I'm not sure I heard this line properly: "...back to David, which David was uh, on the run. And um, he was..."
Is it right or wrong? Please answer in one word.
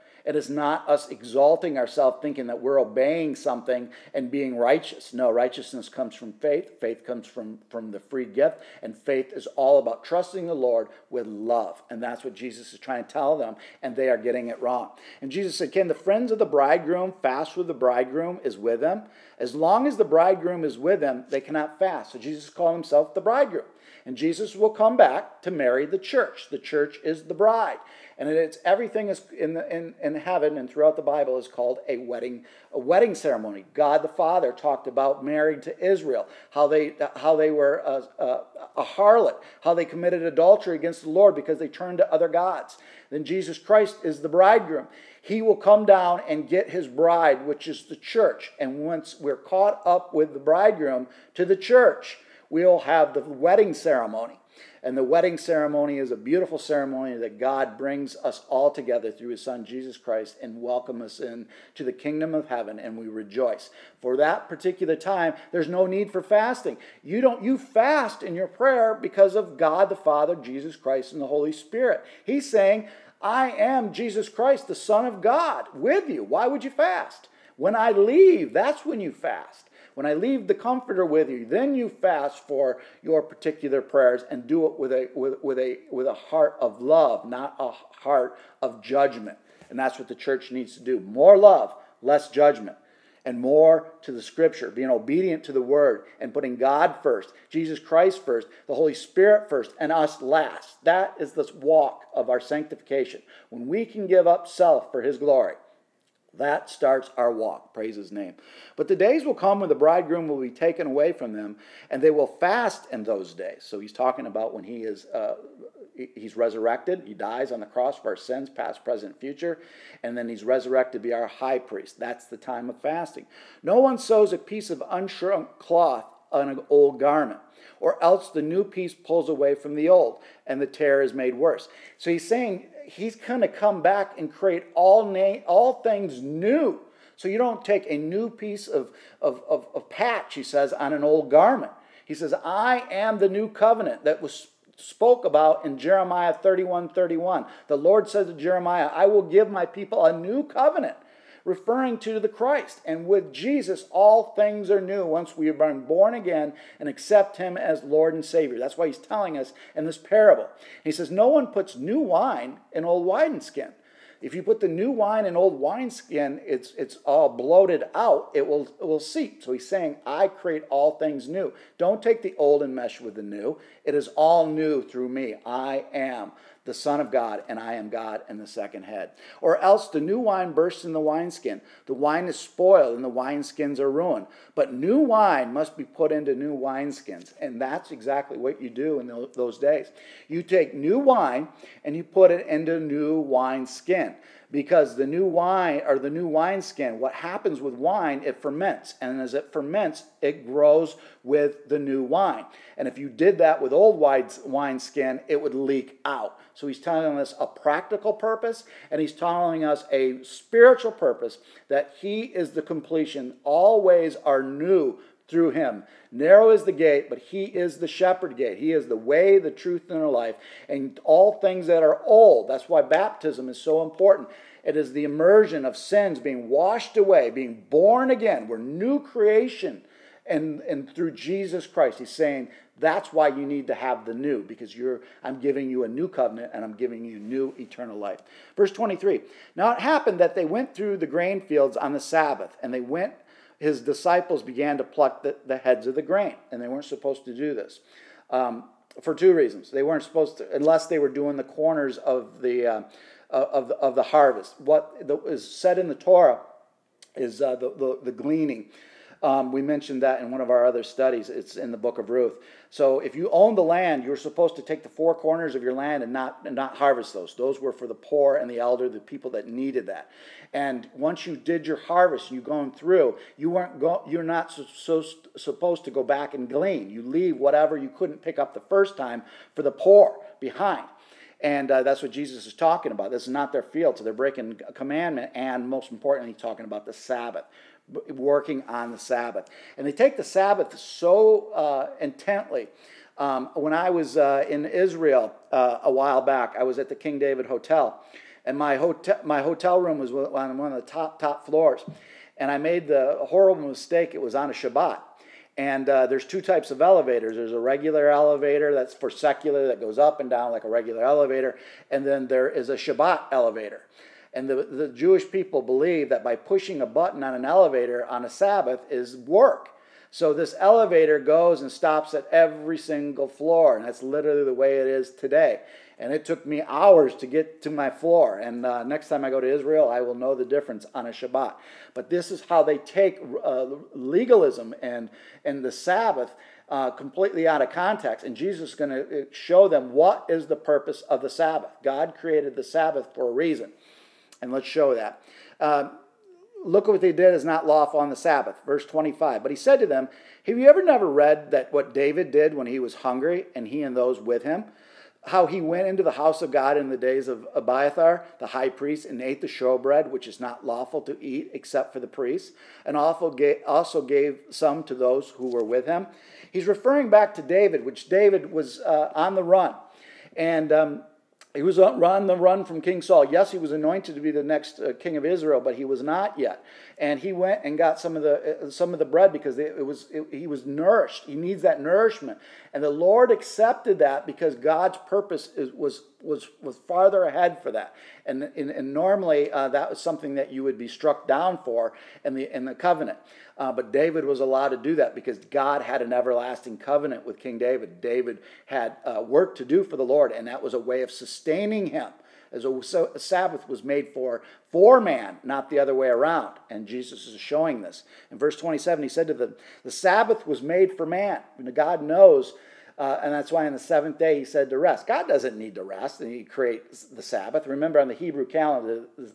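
right.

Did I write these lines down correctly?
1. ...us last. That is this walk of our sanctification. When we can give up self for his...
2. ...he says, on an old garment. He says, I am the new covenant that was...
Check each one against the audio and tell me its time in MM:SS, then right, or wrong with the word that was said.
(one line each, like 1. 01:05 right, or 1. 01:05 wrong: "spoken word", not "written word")
1. 01:39 right
2. 02:20 right.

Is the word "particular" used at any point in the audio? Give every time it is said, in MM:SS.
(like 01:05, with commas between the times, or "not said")
01:04, 01:23.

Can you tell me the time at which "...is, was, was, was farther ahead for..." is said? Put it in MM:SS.
06:25.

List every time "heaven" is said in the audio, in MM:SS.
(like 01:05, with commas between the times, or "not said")
00:30, 01:02.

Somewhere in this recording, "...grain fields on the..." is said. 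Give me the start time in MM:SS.
04:01.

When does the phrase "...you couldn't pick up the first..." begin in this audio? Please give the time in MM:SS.
04:37.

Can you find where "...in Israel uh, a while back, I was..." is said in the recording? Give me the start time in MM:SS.
04:54.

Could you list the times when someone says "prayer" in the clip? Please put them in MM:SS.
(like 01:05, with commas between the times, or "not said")
01:08, 01:23.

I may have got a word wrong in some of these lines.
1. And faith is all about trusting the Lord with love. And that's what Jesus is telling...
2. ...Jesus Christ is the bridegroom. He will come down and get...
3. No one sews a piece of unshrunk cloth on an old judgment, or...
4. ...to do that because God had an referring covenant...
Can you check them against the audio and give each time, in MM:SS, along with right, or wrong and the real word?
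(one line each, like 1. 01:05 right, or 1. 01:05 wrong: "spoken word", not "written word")
1. 00:08 wrong: "trying", not "telling"
2. 00:43 right
3. 02:03 wrong: "garment", not "judgment"
4. 06:34 wrong: "everlasting", not "referring".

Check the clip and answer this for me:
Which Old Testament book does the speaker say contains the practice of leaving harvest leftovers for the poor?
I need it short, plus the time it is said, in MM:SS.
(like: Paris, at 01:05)
Ruth, at 04:22.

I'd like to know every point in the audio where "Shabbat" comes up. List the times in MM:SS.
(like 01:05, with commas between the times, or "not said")
05:04, 05:12, 05:31.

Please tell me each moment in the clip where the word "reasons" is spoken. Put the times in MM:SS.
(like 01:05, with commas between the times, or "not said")
04:09, 05:43.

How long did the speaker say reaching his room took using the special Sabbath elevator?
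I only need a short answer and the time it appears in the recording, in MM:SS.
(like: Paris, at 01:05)
hours, at 05:26.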